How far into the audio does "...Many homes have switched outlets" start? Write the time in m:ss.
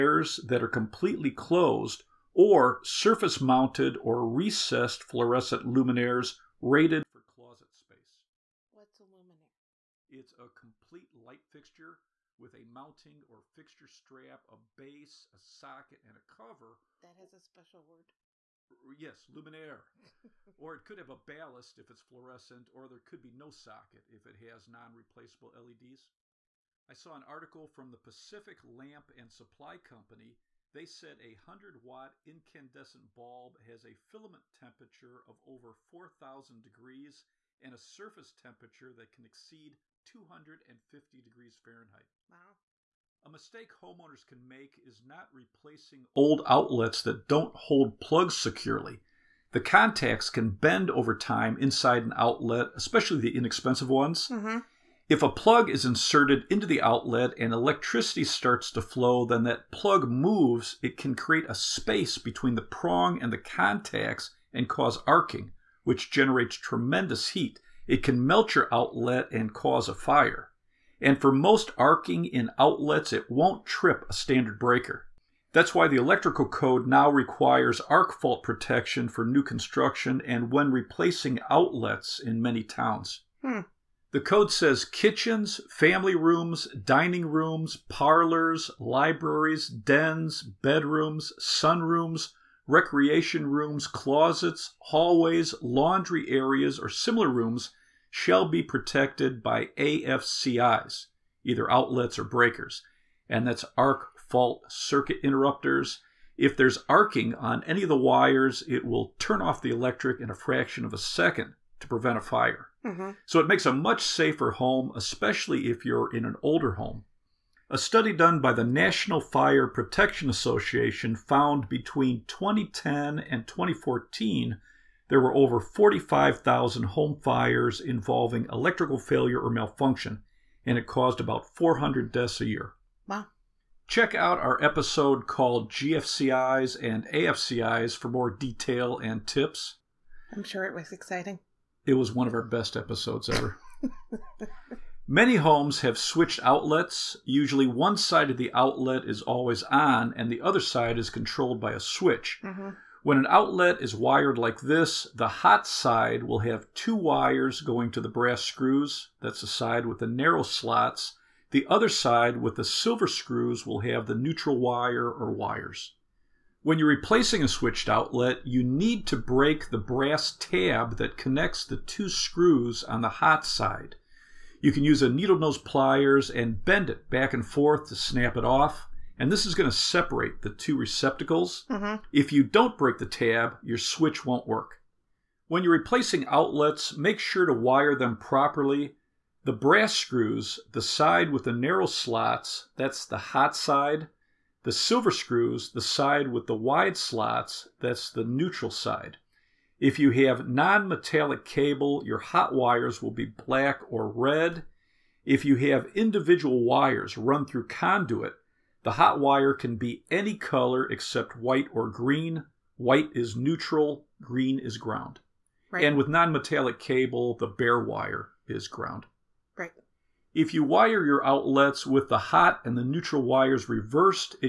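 2:25.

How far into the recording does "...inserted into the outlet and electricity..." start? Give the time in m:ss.
0:55.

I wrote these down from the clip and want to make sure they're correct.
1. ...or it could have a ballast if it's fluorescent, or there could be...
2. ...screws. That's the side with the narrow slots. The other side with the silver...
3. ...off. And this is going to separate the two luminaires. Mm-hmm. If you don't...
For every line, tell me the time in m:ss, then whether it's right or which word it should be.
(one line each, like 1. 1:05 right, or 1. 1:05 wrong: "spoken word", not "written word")
1. 0:20 right
2. 2:38 right
3. 2:58 wrong: "receptacles", not "luminaires".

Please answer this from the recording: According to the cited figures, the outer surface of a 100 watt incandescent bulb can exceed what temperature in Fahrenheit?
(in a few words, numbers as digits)
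250 degrees.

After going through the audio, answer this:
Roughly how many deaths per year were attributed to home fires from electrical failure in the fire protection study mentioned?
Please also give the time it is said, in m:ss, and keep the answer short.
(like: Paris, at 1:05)
400, at 2:11.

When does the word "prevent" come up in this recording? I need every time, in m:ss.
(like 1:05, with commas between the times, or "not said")
1:51.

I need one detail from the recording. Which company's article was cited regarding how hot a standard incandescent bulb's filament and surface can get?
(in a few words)
Pacific Lamp and Supply Company.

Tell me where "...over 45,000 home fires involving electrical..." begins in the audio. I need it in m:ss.
2:05.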